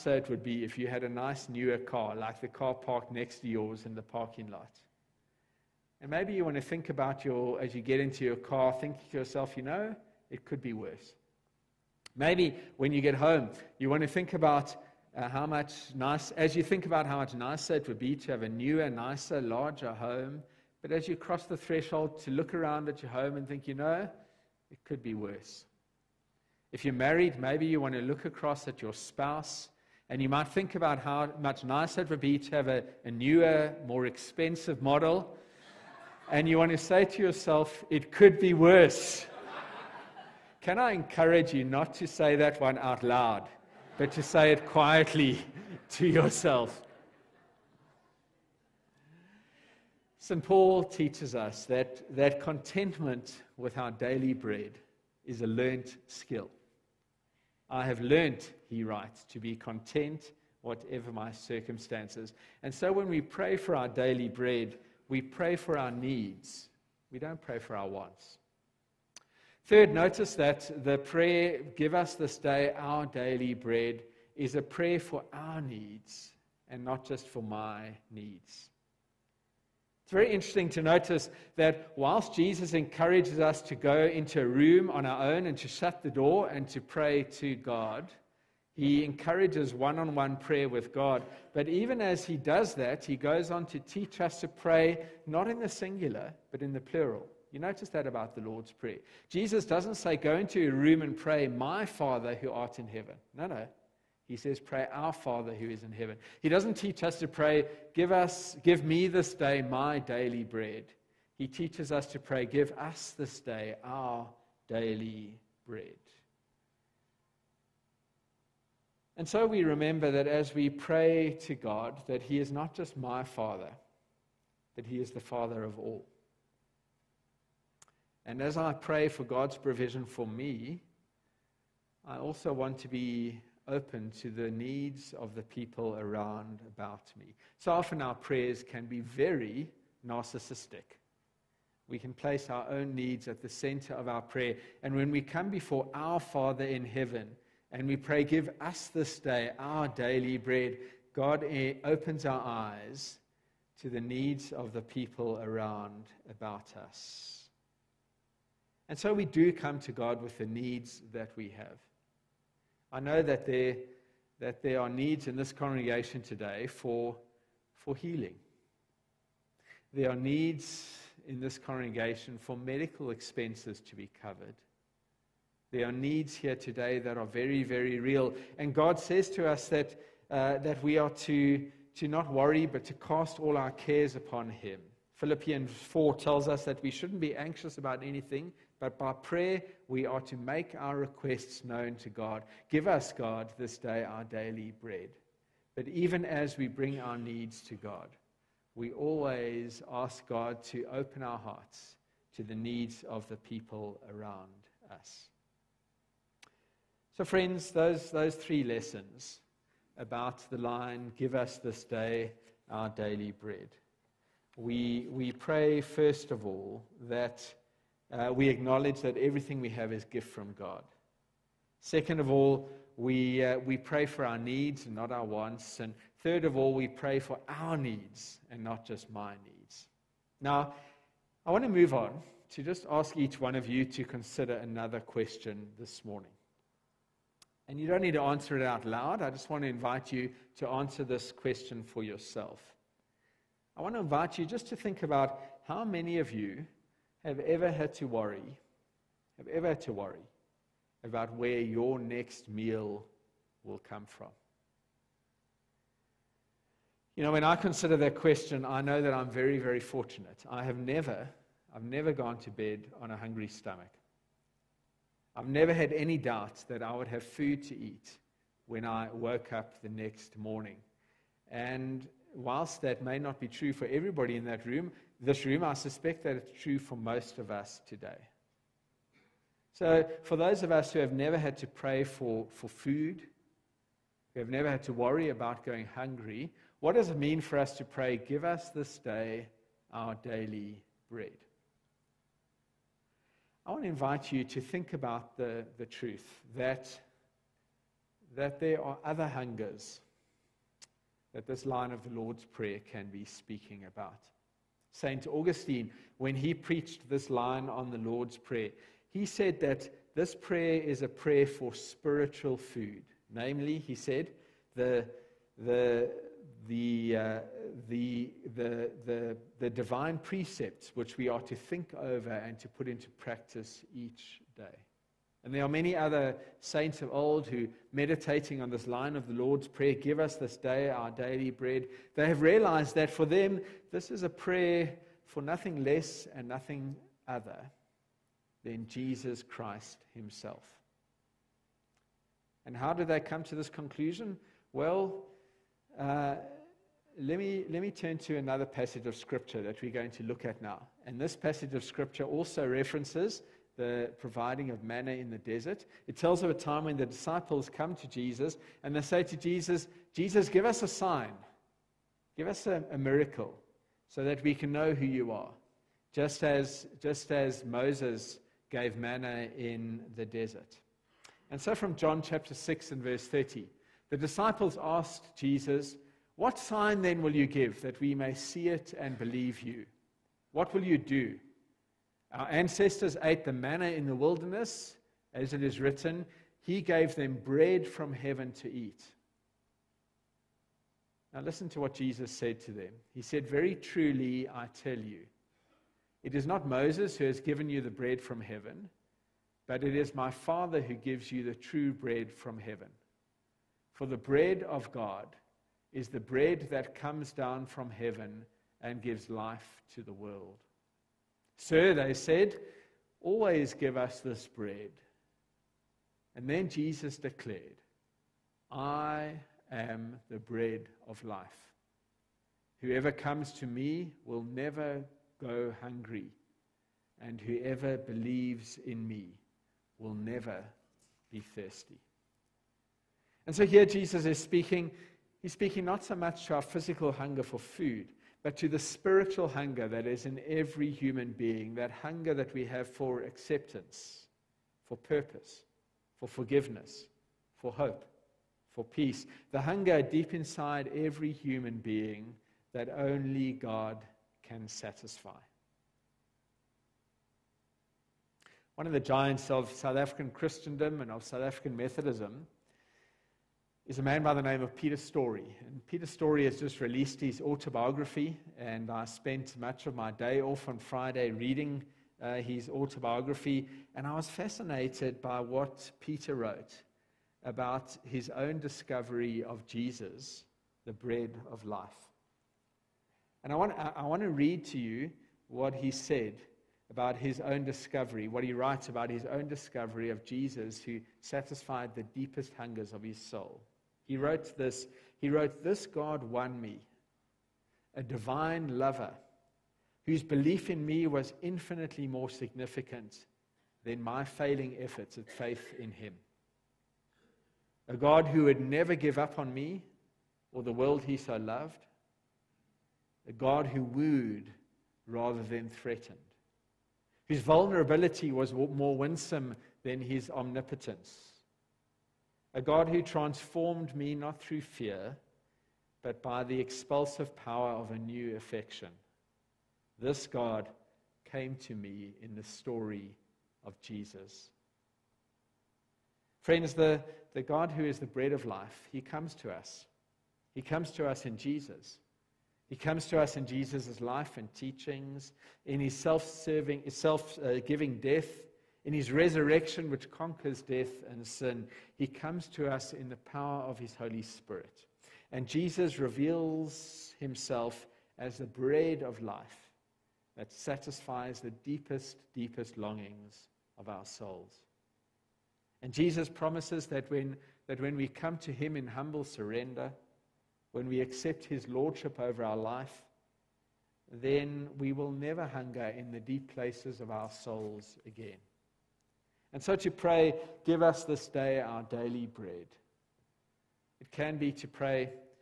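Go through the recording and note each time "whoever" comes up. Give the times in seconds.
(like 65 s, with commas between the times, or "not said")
422 s, 427 s.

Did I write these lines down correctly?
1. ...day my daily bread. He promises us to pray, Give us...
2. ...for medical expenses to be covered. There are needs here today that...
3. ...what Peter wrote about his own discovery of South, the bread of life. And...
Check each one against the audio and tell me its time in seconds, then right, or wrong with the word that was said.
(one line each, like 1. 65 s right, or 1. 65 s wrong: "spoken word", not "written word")
1. 109 s wrong: "teaches", not "promises"
2. 172 s right
3. 475 s wrong: "Jesus", not "South".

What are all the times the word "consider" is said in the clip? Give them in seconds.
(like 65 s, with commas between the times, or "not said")
234 s, 257 s.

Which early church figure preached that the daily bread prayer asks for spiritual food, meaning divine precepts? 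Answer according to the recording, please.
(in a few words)
St. Augustine.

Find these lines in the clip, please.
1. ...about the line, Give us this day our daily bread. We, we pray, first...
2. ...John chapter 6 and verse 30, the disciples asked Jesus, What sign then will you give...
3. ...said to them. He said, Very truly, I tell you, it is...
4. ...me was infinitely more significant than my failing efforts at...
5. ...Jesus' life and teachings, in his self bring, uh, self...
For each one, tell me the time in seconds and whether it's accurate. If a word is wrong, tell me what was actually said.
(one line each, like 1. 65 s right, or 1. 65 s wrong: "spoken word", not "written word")
1. 209 s right
2. 371 s right
3. 392 s right
4. 500 s right
5. 543 s wrong: "serving", not "bring".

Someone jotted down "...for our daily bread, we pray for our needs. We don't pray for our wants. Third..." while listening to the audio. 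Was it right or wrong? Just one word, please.
right.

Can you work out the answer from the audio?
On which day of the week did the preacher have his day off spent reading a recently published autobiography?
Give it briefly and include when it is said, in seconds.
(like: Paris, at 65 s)
Friday, at 470 s.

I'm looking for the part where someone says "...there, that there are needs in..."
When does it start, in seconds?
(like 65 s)
163 s.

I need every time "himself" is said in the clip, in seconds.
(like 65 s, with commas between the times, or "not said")
340 s, 557 s.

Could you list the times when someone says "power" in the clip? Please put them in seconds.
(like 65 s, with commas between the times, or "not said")
527 s, 553 s.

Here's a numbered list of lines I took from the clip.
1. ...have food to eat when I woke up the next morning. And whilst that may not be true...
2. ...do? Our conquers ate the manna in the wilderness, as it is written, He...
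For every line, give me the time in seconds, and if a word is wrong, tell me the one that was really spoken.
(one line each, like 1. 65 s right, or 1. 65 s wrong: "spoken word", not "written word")
1. 267 s right
2. 380 s wrong: "ancestors", not "conquers".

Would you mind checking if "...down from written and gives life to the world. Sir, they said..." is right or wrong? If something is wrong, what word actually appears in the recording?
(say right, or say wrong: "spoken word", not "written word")
wrong: "heaven", not "written".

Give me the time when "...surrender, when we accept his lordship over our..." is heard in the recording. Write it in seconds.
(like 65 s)
569 s.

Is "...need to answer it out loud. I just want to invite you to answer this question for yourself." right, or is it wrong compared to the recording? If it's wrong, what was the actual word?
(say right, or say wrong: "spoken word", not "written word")
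right.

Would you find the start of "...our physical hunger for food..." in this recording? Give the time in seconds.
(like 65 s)
436 s.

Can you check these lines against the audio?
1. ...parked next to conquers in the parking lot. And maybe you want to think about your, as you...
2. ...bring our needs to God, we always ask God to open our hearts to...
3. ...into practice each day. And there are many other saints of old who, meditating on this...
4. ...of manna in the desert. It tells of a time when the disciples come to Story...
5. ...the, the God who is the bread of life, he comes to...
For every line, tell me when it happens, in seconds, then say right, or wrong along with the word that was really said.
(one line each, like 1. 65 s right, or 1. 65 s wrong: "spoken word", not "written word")
1. 2 s wrong: "yours", not "conquers"
2. 196 s right
3. 322 s right
4. 354 s wrong: "Jesus", not "Story"
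5. 536 s right.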